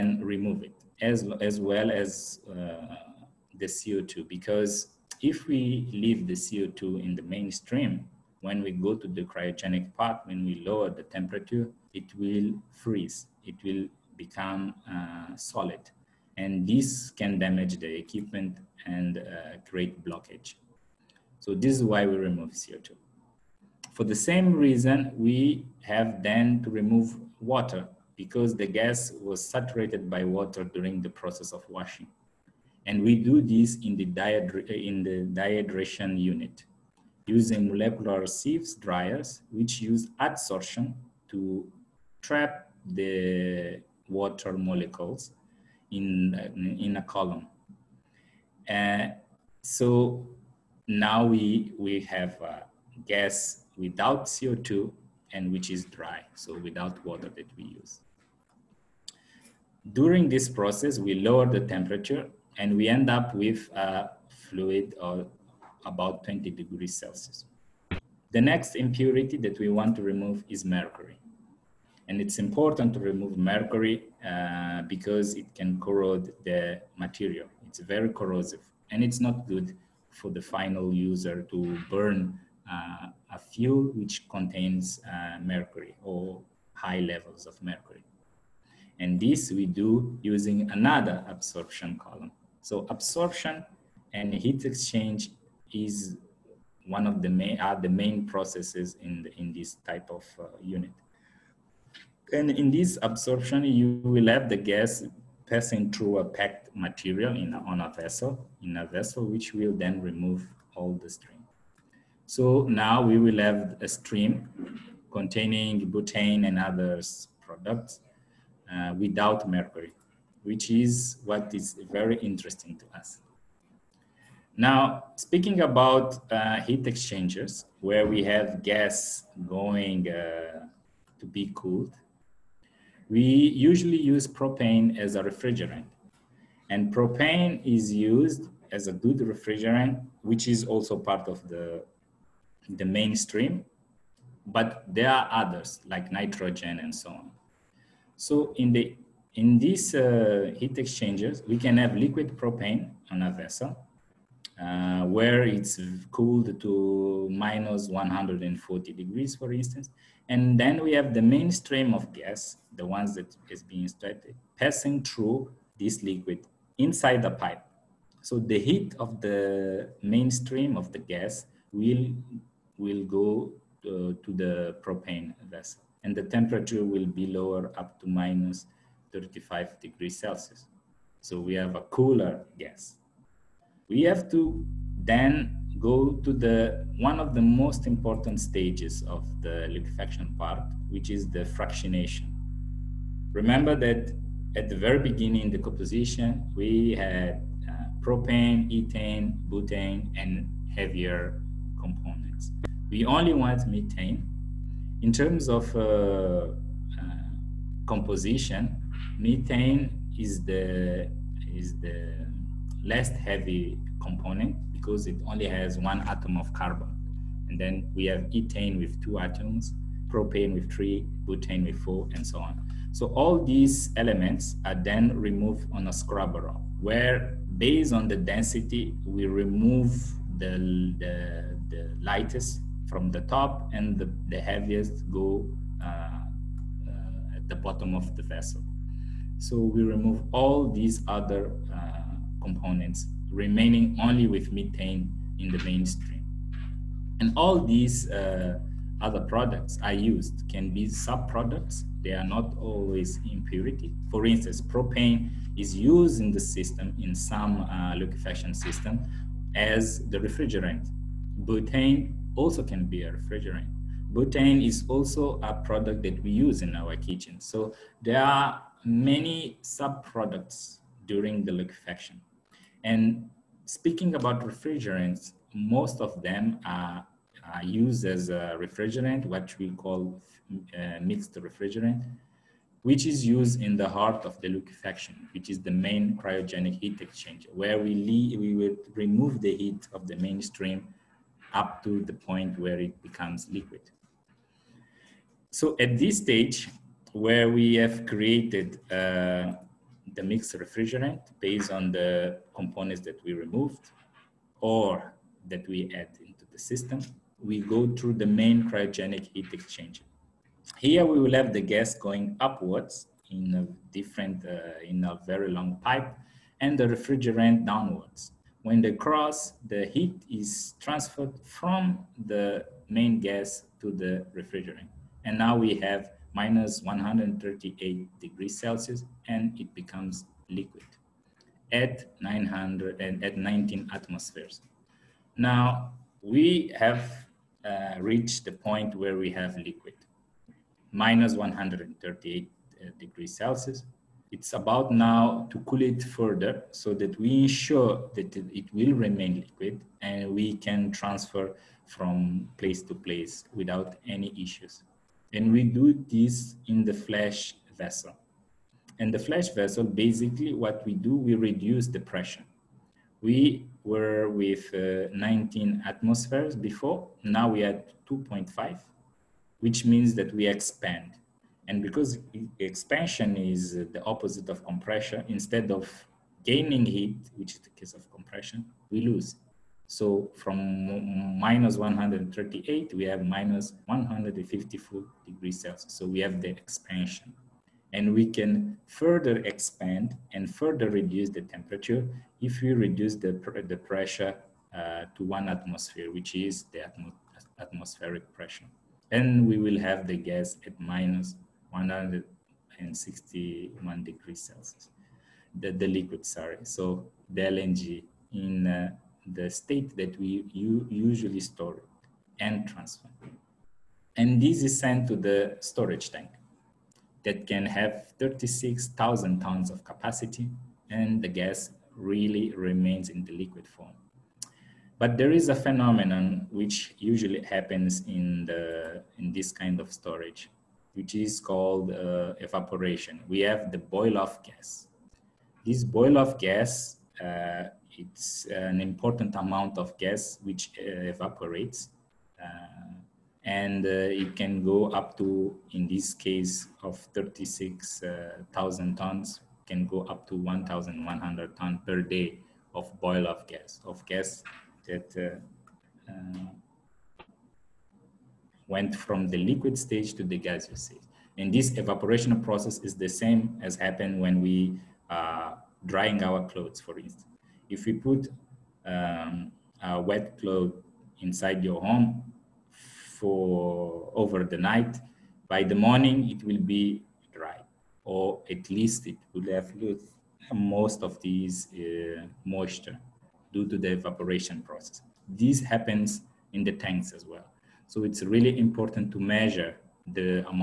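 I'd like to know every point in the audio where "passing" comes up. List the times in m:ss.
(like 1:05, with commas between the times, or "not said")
1:45, 2:44.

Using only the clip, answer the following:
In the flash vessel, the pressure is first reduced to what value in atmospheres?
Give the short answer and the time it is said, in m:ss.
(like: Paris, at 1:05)
2.5, at 6:08.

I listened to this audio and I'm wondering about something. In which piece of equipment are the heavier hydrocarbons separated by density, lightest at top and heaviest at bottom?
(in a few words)
Scrubber.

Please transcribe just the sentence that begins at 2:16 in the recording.
And propane is used as a good refrigerant, which is also part of the, the mainstream.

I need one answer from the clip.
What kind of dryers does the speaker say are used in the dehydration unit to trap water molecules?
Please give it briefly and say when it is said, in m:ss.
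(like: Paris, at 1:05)
Molecular sieves dryers, at 0:37.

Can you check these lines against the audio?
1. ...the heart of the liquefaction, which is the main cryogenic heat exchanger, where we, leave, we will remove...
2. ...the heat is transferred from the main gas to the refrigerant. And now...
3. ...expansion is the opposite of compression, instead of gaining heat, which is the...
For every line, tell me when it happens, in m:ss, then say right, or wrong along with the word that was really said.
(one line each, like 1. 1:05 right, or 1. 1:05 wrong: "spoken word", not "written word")
1. 4:43 right
2. 5:19 right
3. 6:12 right.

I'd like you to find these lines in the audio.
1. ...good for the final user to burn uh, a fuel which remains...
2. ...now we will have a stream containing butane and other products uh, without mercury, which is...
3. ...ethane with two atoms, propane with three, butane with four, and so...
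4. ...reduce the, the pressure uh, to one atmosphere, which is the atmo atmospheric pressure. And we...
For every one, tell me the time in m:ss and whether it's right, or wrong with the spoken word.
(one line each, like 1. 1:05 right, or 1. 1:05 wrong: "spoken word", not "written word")
1. 1:19 wrong: "contains", not "remains"
2. 1:52 right
3. 3:38 right
4. 6:32 right.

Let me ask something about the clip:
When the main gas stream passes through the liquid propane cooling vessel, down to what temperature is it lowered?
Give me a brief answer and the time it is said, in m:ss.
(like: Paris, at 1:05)
-35 degrees Celsius, at 2:58.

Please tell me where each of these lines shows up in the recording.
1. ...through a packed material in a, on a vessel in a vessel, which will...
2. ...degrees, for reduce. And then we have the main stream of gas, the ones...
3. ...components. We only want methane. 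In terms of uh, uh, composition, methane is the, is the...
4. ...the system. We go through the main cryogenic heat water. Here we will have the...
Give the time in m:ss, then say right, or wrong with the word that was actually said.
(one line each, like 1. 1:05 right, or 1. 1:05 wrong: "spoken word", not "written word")
1. 1:45 right
2. 2:38 wrong: "instance", not "reduce"
3. 3:21 right
4. 5:06 wrong: "exchanger", not "water".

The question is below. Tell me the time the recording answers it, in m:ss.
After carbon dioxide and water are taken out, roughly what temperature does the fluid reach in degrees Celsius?
1:06.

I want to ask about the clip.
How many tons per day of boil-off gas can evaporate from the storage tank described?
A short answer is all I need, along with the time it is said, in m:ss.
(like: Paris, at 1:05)
1,100, at 7:30.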